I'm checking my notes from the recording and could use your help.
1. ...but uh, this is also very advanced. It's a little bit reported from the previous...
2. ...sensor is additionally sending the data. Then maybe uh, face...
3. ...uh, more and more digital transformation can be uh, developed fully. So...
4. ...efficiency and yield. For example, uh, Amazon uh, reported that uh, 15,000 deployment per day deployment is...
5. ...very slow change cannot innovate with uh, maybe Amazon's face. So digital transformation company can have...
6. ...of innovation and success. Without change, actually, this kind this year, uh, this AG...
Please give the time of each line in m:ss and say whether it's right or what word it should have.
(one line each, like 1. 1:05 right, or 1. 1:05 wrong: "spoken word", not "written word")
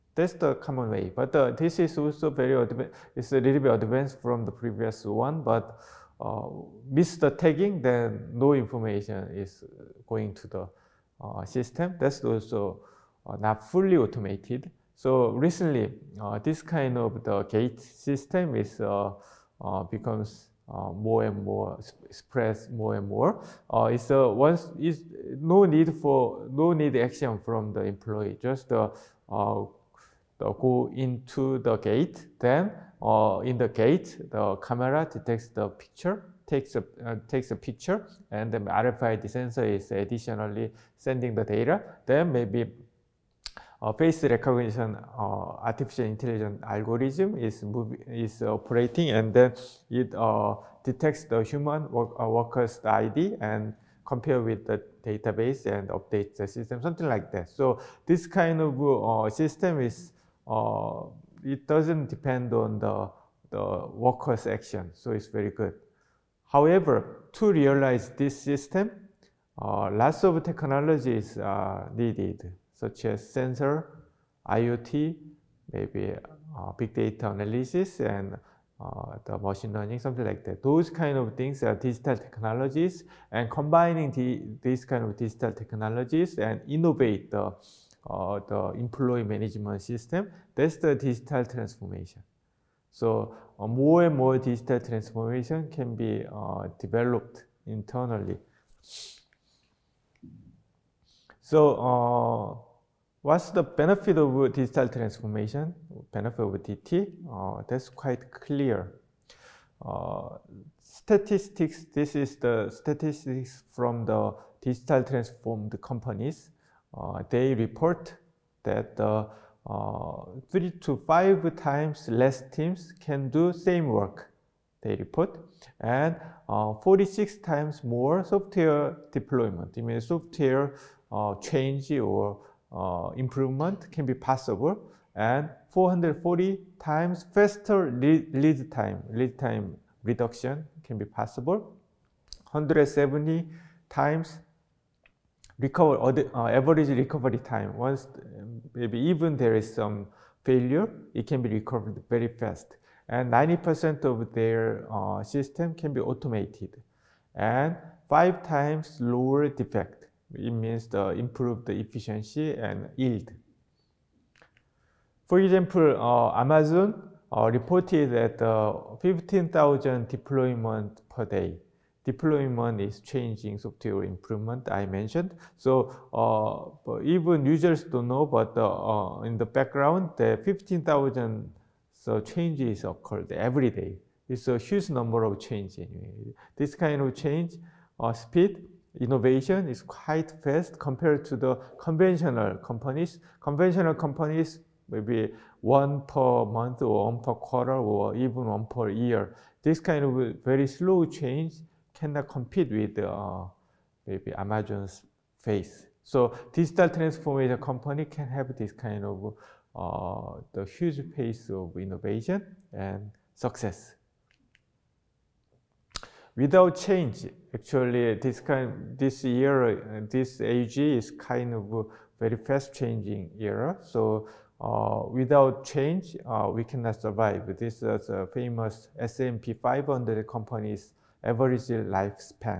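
1. 0:01 wrong: "advanced", not "reported"
2. 0:39 right
3. 1:33 wrong: "internally", not "fully"
4. 2:41 right
5. 3:20 wrong: "compete", not "innovate"
6. 3:31 right.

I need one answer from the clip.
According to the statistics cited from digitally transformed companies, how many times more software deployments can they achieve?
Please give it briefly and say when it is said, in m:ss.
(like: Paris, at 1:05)
46 times, at 2:06.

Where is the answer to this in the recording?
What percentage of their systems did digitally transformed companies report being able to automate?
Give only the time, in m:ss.
2:33.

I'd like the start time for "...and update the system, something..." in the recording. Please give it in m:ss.
0:55.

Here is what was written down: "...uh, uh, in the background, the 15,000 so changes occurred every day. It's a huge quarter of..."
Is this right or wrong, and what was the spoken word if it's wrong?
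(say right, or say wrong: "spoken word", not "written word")
wrong: "number", not "quarter".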